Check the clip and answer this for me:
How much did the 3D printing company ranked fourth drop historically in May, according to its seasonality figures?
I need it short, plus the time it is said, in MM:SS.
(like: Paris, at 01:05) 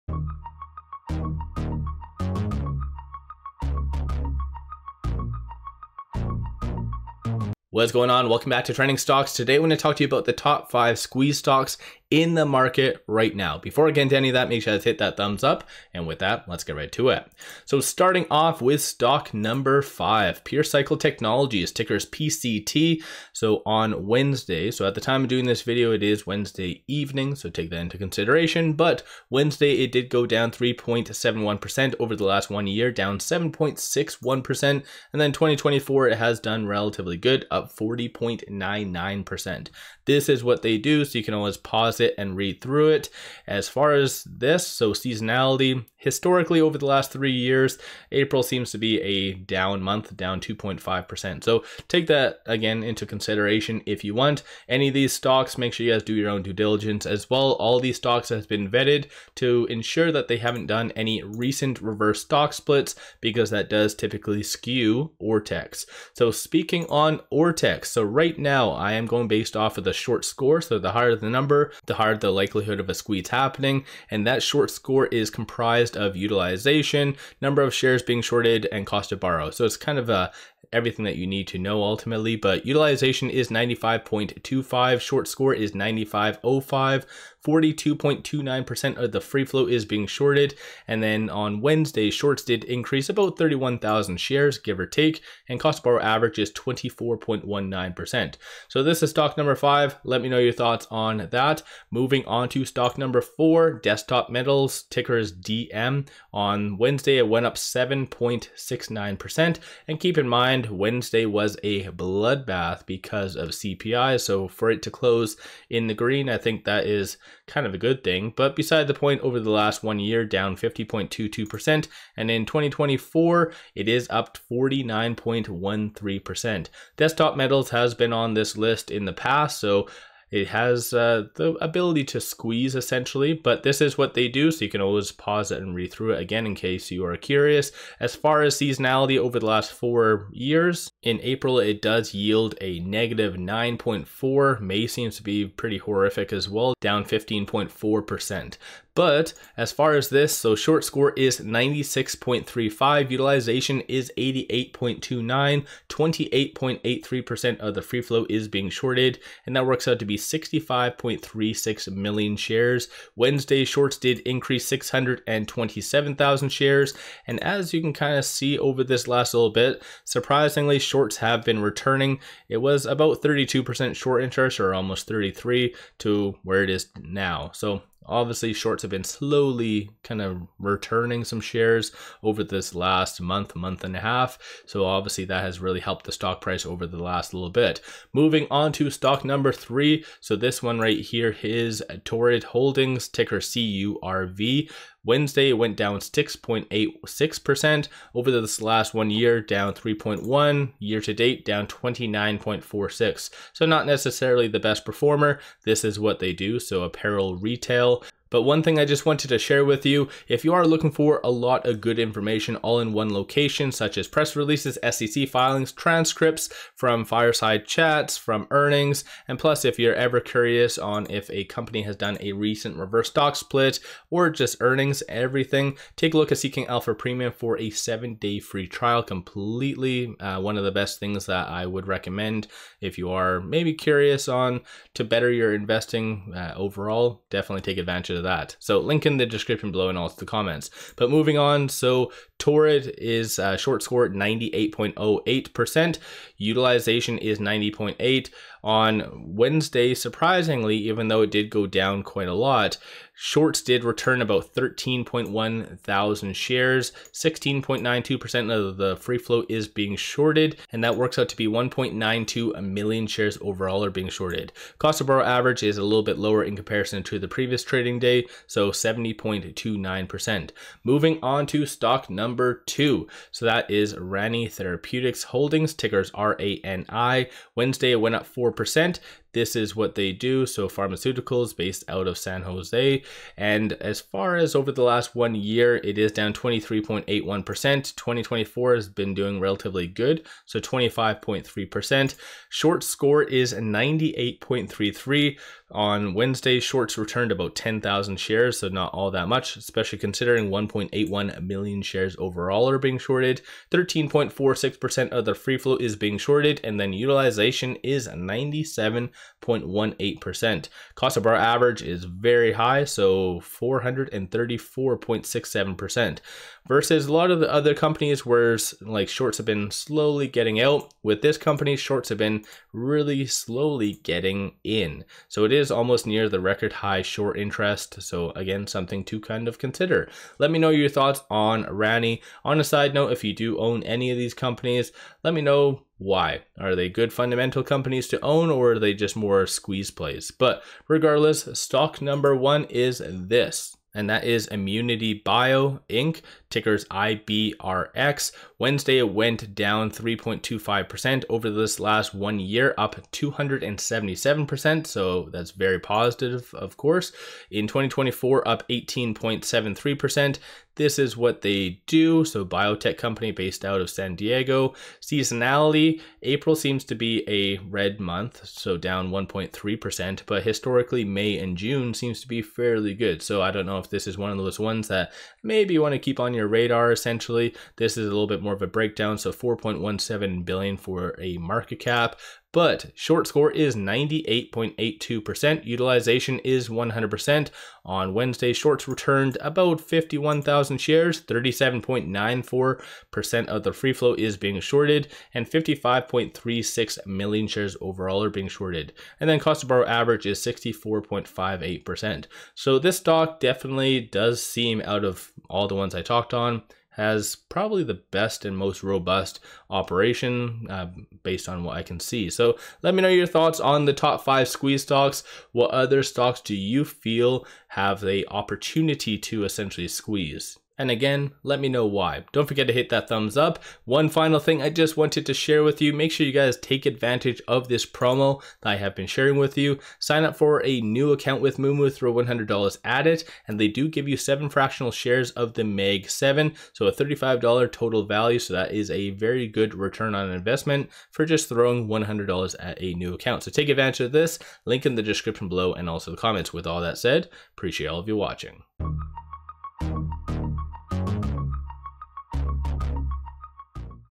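15.4%, at 02:26.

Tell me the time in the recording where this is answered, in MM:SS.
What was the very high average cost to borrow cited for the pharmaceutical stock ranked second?
05:13.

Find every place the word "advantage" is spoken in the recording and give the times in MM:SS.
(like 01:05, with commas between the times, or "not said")
03:57, 07:06, 07:23.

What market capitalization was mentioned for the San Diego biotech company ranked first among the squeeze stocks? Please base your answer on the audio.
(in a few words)
4.17 billion.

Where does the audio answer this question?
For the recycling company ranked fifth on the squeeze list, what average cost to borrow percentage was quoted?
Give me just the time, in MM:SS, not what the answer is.
01:36.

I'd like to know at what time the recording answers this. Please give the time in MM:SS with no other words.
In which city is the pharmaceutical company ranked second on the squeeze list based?
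04:42.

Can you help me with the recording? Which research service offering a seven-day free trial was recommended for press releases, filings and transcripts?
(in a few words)
Seeking Alpha Premium.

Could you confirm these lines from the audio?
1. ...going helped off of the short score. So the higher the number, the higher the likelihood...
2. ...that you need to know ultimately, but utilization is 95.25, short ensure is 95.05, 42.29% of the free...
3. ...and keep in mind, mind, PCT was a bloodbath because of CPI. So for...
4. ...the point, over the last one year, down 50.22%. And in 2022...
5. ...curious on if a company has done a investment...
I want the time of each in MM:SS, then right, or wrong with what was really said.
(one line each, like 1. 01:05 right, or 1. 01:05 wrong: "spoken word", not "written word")
1. 01:09 wrong: "based", not "helped"
2. 01:21 wrong: "score", not "ensure"
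3. 01:49 wrong: "Wednesday", not "PCT"
4. 01:58 wrong: "2024", not "2022"
5. 03:40 wrong: "recent", not "investment".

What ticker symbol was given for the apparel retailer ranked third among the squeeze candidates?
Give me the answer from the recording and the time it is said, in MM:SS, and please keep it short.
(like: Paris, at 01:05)
CURV, at 03:13.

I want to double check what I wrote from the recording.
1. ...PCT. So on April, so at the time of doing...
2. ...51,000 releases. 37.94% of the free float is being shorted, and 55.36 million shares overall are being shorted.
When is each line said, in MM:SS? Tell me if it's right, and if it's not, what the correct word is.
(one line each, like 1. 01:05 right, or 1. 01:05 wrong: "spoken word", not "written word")
1. 00:22 wrong: "Wednesday", not "April"
2. 06:29 wrong: "shares", not "releases".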